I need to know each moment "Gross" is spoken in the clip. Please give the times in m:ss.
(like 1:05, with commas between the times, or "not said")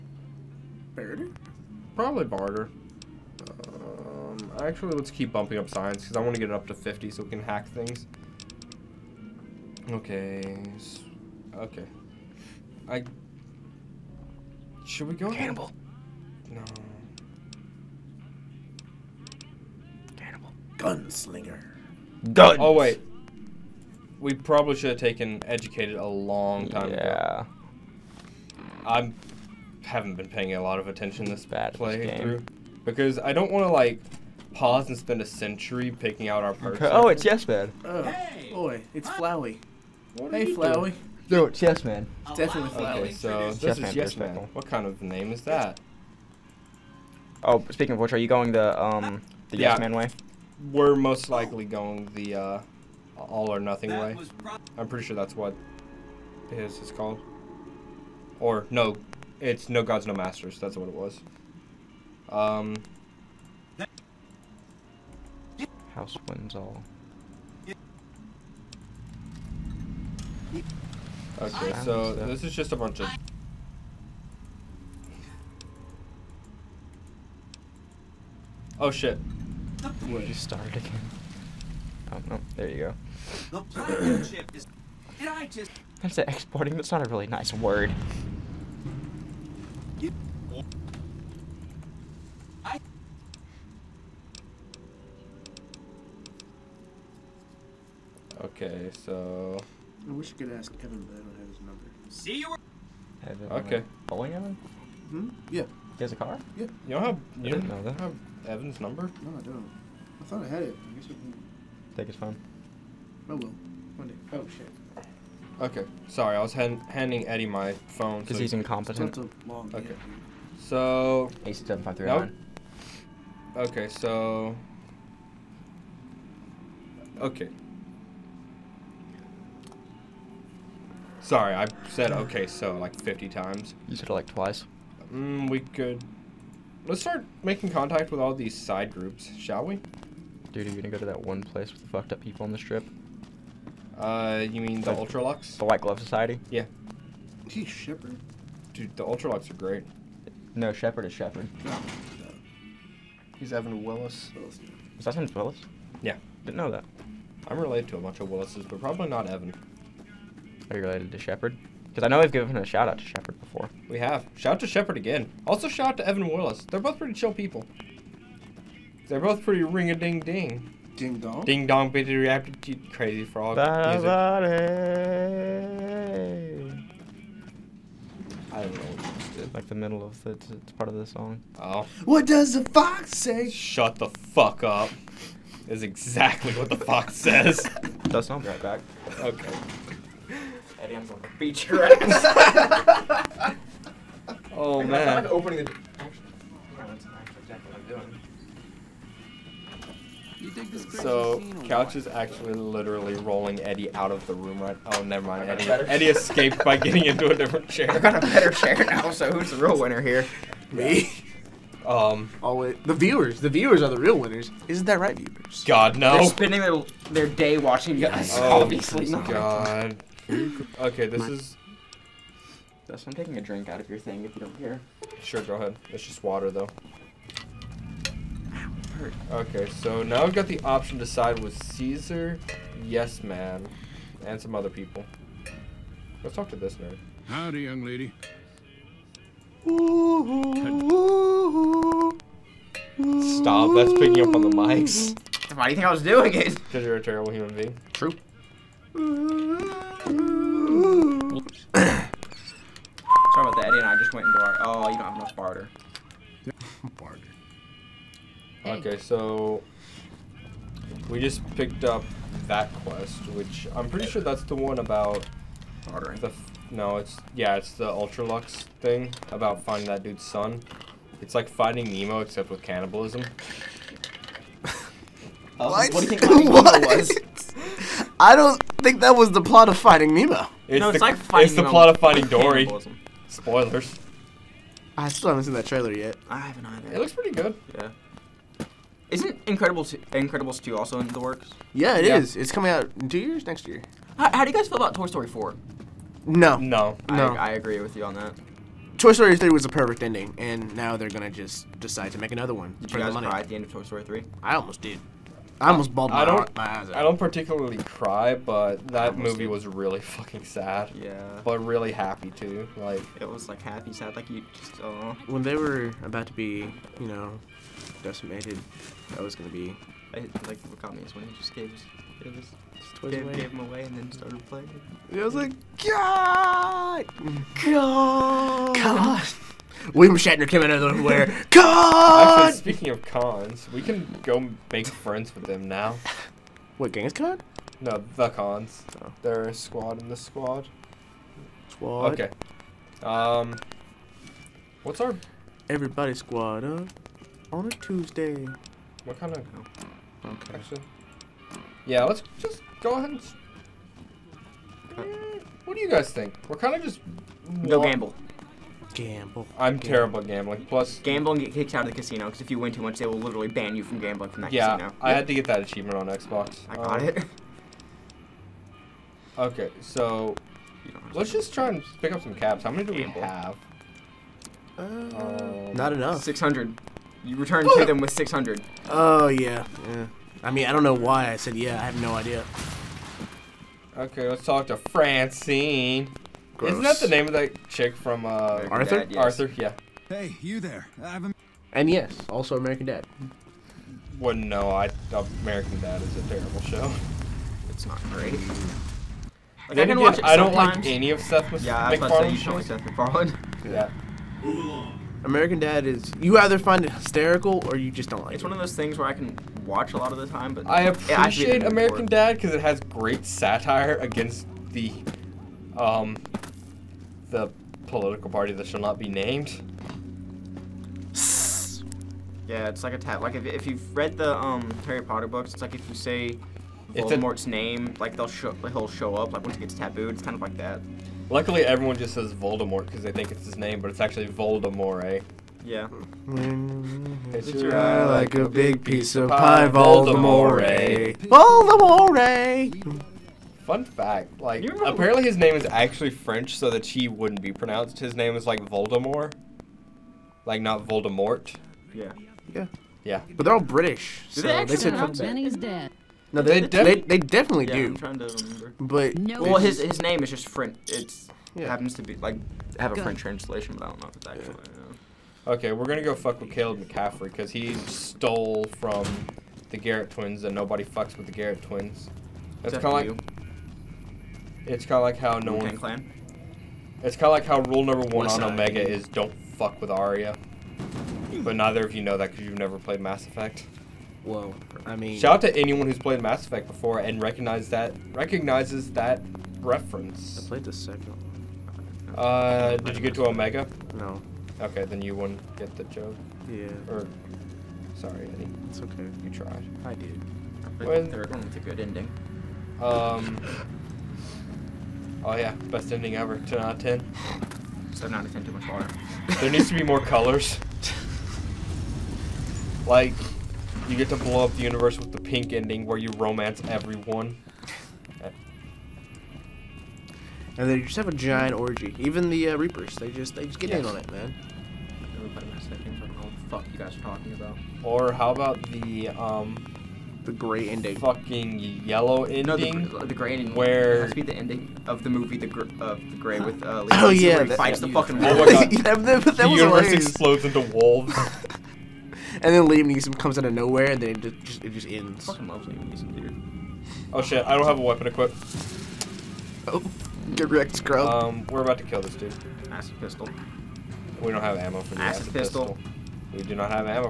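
6:26.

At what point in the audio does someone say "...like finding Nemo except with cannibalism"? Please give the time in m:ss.
4:31.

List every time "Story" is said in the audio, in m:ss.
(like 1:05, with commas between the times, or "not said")
4:55, 4:59, 5:03.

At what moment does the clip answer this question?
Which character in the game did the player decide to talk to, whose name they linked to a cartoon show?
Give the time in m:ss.
6:24.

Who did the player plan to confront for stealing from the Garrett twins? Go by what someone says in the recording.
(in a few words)
Caleb McCaffery.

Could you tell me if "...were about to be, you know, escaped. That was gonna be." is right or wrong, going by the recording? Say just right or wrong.
wrong.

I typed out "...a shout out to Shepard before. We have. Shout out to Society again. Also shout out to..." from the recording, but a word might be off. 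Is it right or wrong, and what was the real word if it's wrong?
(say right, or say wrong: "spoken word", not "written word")
wrong: "Shepard", not "Society".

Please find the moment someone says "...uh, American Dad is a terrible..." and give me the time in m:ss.
6:35.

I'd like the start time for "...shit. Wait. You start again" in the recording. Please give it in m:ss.
1:18.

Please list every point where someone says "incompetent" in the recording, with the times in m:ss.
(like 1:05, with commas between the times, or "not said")
1:58.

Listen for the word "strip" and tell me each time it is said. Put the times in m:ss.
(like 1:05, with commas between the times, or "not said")
2:22.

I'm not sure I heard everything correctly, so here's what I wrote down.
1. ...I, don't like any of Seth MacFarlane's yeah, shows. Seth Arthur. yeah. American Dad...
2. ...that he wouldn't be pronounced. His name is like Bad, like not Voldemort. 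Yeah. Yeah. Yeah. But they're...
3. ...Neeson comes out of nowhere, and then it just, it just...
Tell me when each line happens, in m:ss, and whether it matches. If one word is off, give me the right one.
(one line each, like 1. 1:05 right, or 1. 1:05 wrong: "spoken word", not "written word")
1. 6:40 wrong: "MacFarlane", not "Arthur"
2. 7:26 wrong: "Voldemort", not "Bad"
3. 9:02 right.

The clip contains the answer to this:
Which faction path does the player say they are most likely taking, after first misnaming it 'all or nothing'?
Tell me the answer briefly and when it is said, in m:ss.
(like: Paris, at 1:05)
No gods, no masters, at 0:59.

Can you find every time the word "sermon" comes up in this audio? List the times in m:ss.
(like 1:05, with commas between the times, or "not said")
not said.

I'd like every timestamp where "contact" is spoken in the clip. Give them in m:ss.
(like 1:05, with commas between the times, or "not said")
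2:17.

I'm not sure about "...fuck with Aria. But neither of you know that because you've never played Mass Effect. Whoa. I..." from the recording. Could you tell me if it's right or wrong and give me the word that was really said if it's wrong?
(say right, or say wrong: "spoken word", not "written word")
right.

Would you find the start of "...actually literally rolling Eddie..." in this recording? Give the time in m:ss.
3:22.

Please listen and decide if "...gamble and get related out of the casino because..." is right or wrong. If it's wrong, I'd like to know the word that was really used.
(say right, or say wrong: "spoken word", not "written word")
wrong: "kicked", not "related".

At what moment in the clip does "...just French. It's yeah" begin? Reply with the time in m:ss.
7:40.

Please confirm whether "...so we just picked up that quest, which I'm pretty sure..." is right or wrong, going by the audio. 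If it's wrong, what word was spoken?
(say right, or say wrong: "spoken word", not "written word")
right.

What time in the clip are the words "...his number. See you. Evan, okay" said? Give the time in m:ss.
1:41.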